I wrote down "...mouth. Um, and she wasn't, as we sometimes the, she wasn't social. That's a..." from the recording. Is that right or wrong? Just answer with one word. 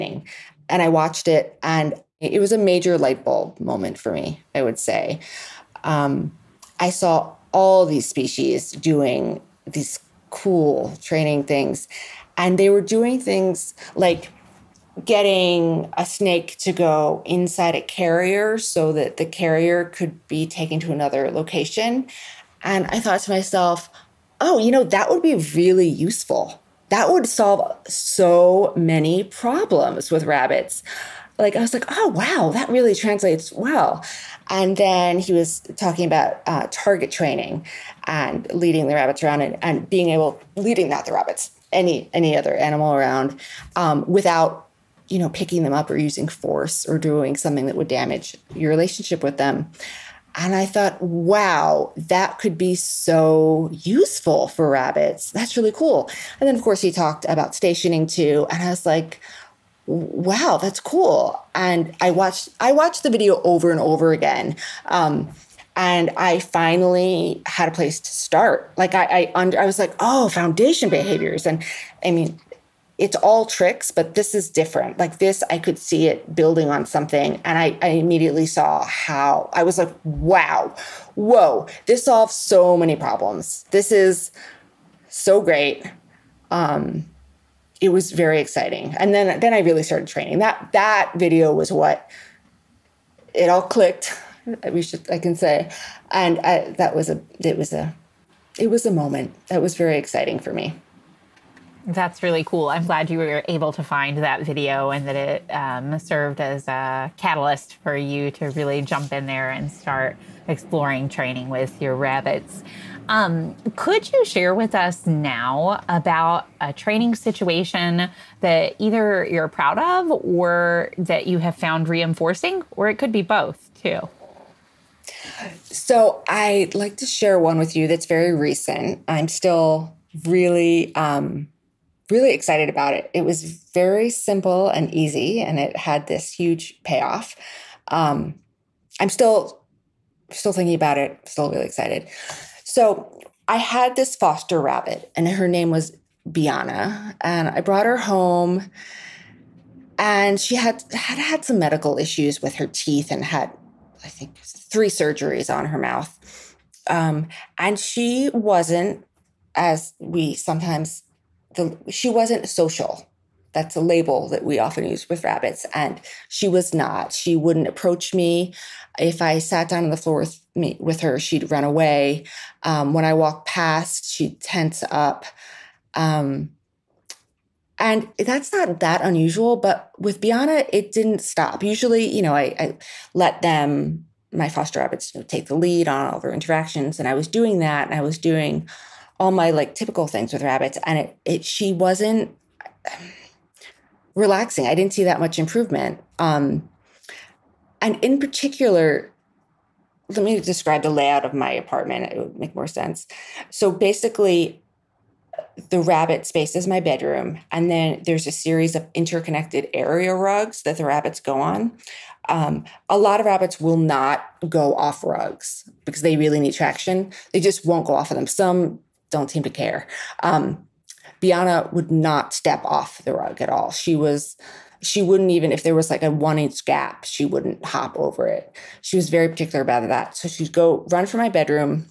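right.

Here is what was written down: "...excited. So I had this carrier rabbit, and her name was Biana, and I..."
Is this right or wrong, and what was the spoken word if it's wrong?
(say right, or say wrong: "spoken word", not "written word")
wrong: "foster", not "carrier".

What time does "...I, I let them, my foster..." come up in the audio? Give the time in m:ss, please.
3:02.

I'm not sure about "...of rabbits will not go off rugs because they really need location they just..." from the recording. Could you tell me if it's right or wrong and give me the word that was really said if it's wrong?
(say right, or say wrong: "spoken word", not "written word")
wrong: "traction", not "location".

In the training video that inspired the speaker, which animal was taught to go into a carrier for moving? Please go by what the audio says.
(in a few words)
Snake.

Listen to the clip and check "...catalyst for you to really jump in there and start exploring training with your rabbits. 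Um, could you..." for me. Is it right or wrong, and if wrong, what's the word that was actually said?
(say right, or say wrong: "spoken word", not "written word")
right.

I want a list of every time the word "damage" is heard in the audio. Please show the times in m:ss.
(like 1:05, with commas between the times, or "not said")
0:47.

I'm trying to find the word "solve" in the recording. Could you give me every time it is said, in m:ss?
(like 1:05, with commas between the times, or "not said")
0:27, 1:22.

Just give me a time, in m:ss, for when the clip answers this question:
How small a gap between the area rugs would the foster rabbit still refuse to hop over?
3:46.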